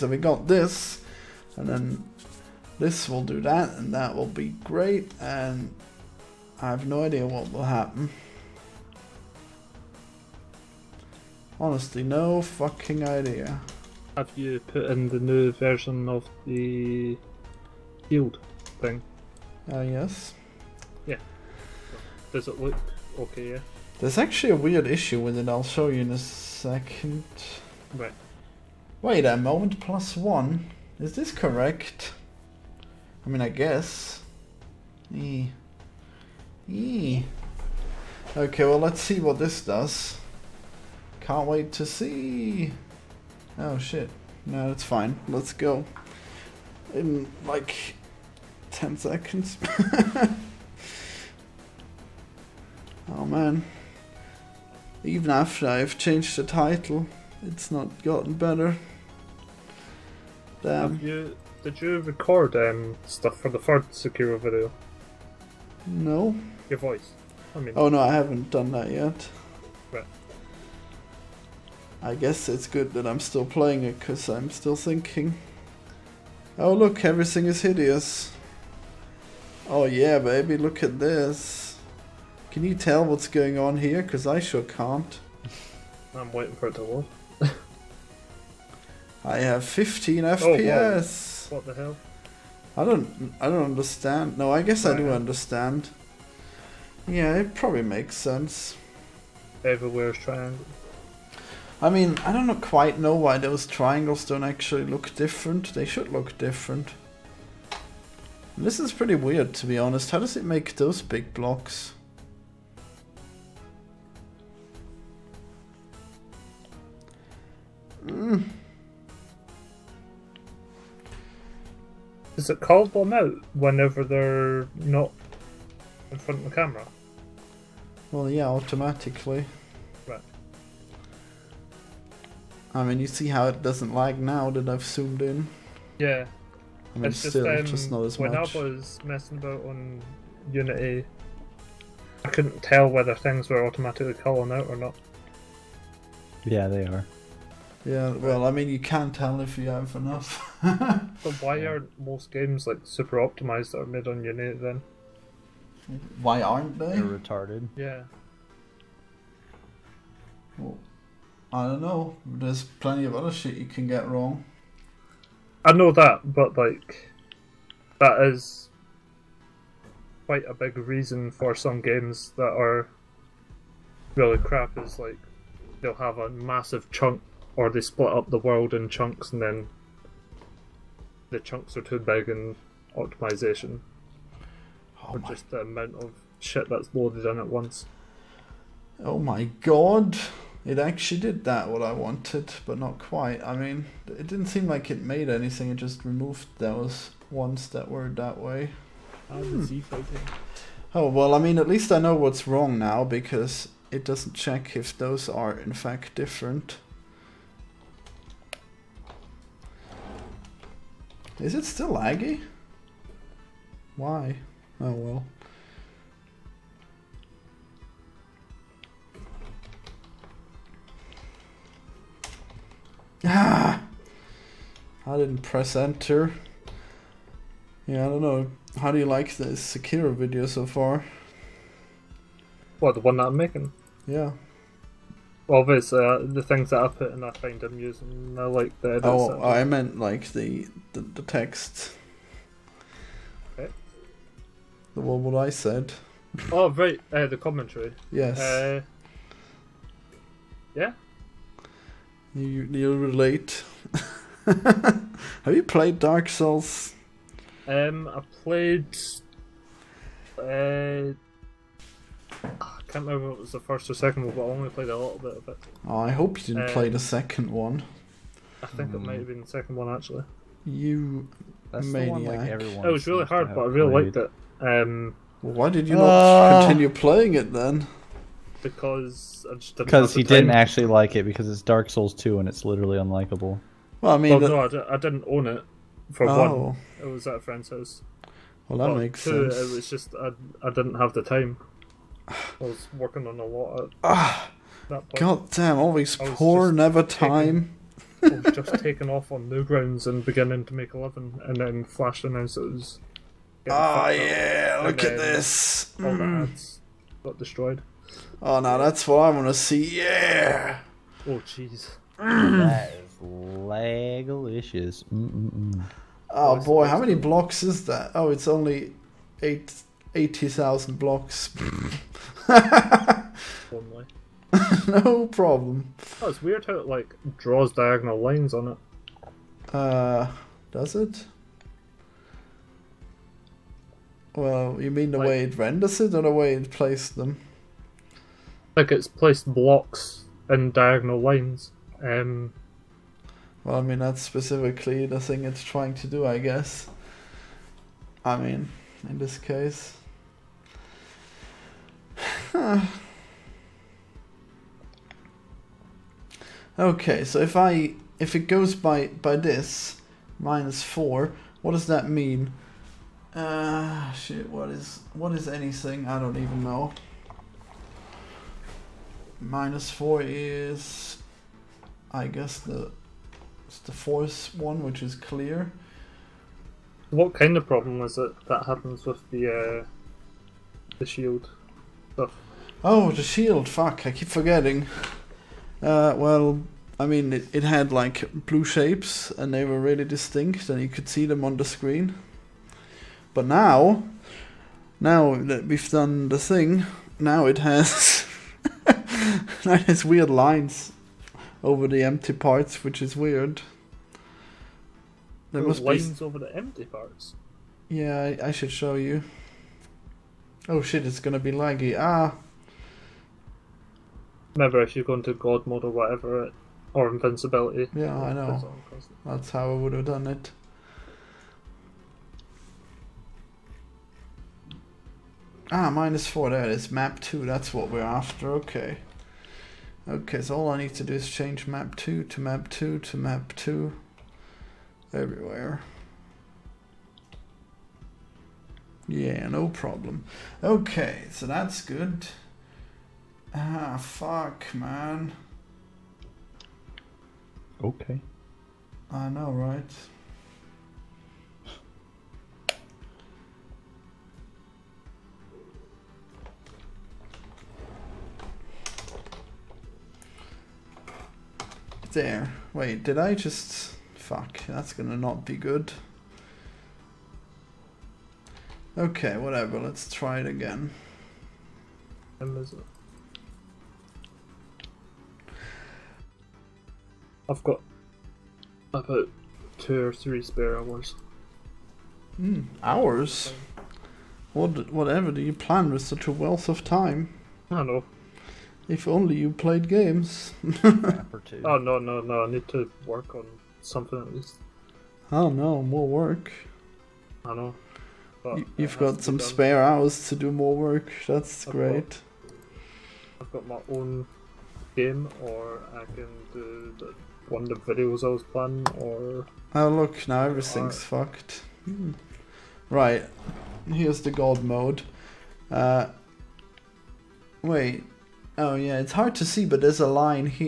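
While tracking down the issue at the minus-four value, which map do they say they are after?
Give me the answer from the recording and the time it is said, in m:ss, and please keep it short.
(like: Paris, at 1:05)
map 2, at 7:06.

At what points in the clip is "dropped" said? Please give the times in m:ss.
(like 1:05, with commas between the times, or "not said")
not said.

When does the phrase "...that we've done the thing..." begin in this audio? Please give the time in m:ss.
6:35.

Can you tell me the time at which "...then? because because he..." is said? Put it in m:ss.
4:37.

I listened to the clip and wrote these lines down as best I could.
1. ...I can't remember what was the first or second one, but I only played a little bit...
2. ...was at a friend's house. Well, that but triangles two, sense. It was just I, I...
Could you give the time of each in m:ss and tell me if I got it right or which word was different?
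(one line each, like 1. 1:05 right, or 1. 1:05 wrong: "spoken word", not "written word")
1. 4:22 right
2. 4:47 wrong: "makes", not "triangles".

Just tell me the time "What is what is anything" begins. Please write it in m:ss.
6:04.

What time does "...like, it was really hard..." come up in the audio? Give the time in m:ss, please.
4:32.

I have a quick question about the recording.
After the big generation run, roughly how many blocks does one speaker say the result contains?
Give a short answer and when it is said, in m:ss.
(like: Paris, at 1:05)
80,000, at 5:20.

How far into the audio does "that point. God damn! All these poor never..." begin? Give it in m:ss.
4:54.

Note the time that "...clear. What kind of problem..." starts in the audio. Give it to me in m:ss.
6:15.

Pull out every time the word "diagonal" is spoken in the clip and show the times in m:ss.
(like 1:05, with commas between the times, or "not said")
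5:27, 5:40.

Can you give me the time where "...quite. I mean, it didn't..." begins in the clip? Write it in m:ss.
3:12.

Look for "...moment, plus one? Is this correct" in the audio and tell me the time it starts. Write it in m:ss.
0:29.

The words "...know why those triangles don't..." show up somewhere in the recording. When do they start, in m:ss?
1:42.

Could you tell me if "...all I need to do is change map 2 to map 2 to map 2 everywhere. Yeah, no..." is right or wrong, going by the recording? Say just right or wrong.
right.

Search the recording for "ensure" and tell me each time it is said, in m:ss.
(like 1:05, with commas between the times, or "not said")
not said.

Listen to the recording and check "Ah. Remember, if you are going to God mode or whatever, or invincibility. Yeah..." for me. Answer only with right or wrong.
right.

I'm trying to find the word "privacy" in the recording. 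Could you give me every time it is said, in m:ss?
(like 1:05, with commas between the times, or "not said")
not said.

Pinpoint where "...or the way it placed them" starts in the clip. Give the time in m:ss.
5:36.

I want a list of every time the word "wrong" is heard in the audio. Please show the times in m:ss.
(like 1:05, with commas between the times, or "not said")
2:44, 3:22.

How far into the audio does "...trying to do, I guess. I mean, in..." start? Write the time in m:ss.
5:45.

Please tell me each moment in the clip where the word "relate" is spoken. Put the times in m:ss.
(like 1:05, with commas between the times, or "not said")
4:12.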